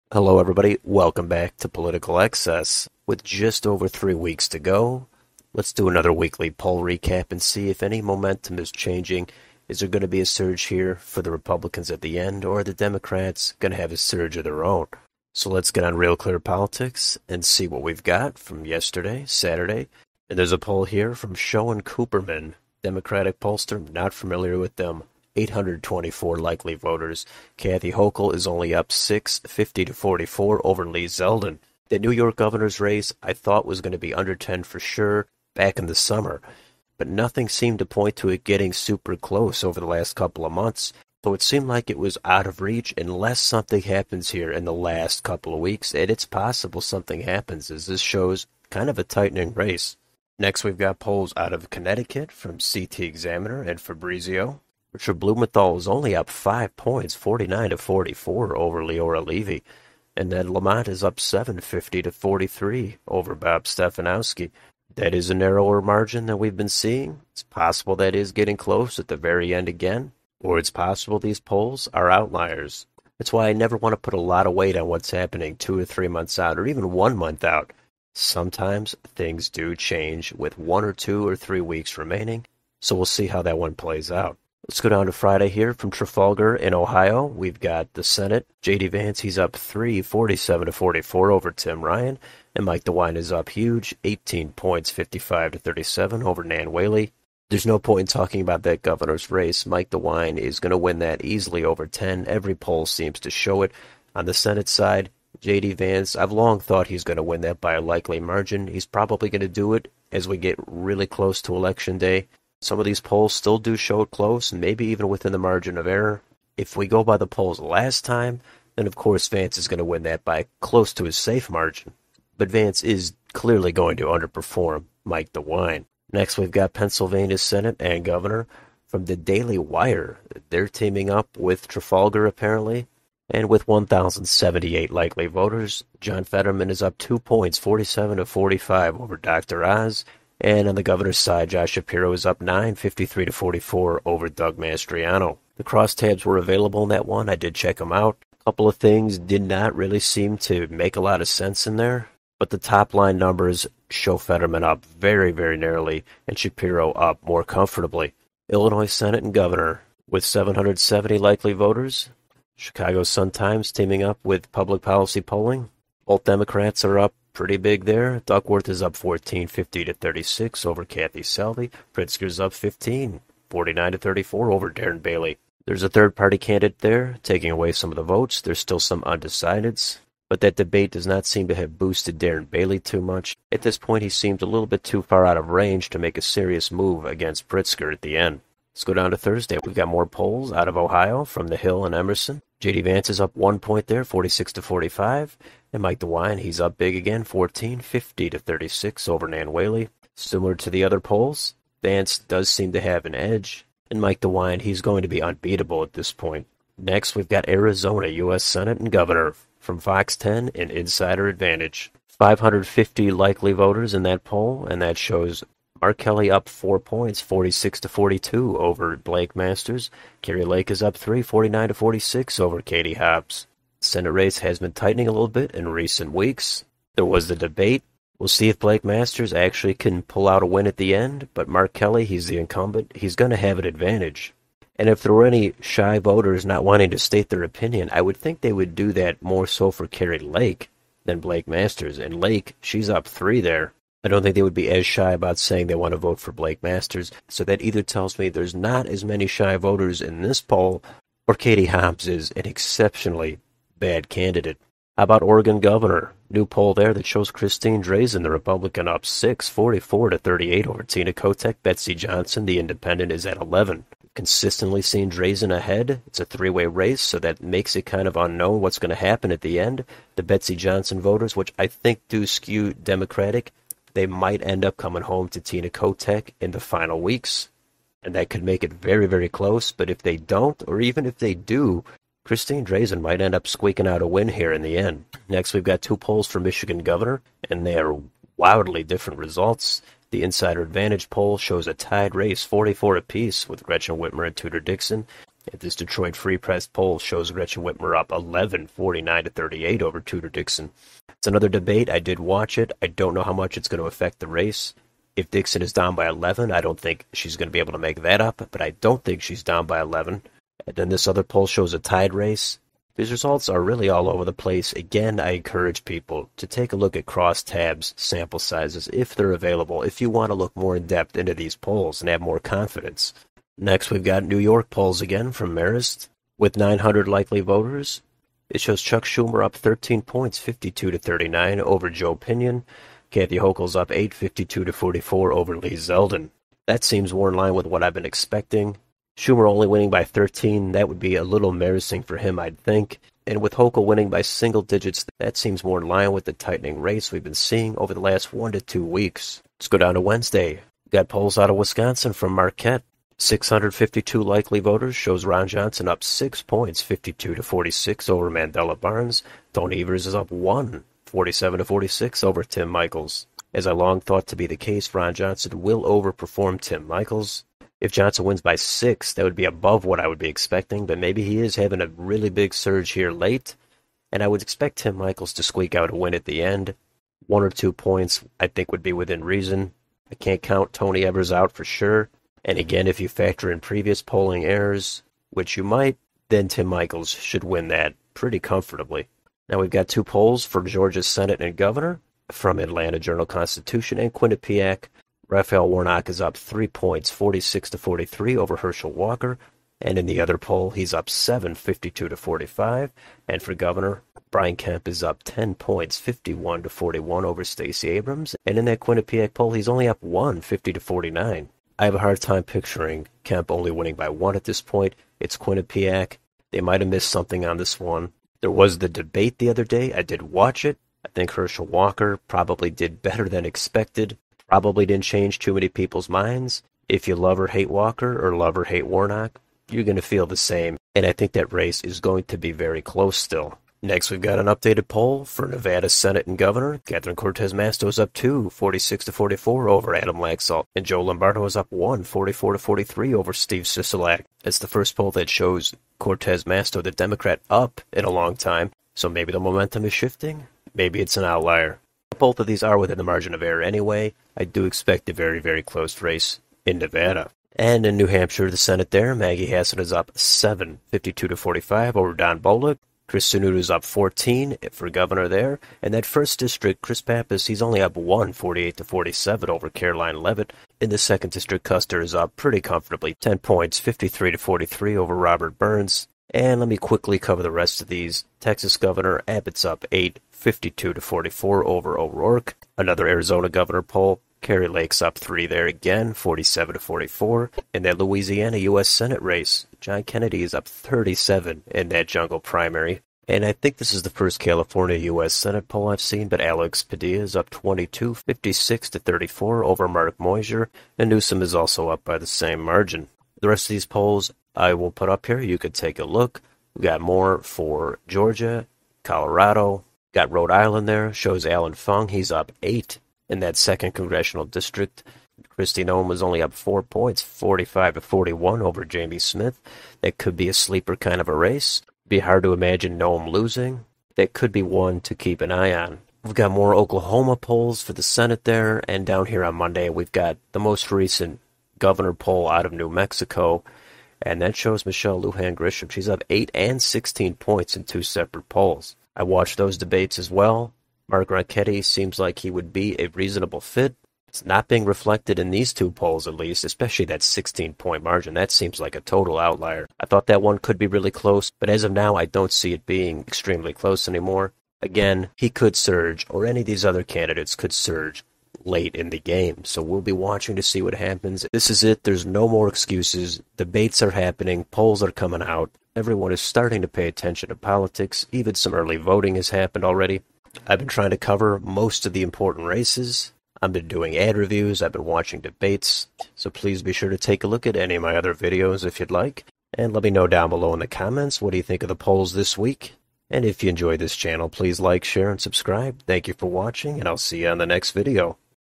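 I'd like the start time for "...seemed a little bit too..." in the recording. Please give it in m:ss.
3:04.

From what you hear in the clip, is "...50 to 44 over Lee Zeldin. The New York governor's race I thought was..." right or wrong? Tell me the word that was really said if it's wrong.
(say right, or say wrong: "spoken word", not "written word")
right.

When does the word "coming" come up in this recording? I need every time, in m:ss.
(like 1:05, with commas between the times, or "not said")
4:34, 9:25.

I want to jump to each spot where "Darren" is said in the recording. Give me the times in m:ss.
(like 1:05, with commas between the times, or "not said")
2:54, 3:02.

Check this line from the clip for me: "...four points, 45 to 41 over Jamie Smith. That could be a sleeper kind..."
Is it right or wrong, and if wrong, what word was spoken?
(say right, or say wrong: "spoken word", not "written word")
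right.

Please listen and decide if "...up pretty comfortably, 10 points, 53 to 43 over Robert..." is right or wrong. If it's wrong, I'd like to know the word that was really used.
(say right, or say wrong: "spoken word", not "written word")
right.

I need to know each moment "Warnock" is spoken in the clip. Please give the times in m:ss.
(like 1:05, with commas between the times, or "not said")
6:35, 7:08.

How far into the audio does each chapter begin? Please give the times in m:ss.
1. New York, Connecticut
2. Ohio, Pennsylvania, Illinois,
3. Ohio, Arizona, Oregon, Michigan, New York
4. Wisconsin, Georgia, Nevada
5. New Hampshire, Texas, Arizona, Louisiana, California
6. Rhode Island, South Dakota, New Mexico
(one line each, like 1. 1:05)
1. 0:14
2. 1:24
3. 3:08
4. 5:49
5. 7:37
6. 8:26.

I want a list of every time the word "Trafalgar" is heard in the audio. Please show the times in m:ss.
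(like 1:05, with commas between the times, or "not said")
1:25, 2:11.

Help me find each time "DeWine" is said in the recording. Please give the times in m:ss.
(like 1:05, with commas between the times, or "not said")
1:32, 1:39, 2:05, 3:15, 3:24.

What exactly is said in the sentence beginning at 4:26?
It's a three way race, so that makes it kind of unknown what's going to happen at the end.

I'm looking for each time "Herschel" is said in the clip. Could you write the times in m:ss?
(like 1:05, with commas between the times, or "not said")
6:38, 7:01.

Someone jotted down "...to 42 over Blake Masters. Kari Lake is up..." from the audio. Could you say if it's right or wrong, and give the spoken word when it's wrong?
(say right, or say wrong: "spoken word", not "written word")
right.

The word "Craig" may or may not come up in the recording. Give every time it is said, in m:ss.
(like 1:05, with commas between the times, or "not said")
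not said.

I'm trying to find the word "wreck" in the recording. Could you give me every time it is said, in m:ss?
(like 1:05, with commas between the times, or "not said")
not said.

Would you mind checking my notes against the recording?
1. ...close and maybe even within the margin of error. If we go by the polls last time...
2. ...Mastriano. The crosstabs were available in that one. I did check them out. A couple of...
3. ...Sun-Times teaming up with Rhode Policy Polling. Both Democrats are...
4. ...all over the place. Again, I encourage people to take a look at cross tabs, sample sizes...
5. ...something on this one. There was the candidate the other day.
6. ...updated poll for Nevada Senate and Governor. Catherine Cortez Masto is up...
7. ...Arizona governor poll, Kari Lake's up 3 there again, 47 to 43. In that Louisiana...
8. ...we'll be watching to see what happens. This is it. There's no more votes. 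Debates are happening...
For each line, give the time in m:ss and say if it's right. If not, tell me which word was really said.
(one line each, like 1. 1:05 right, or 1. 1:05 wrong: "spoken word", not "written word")
1. 1:54 right
2. 2:24 right
3. 2:43 wrong: "Public", not "Rhode"
4. 5:13 right
5. 6:57 wrong: "debate", not "candidate"
6. 7:14 right
7. 8:03 wrong: "44", not "43"
8. 9:19 wrong: "excuses", not "votes".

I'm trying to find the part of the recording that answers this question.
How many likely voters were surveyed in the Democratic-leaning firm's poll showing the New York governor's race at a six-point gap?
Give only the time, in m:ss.
0:25.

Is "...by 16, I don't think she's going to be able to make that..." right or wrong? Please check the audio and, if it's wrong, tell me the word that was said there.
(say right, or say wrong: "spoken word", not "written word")
wrong: "11", not "16".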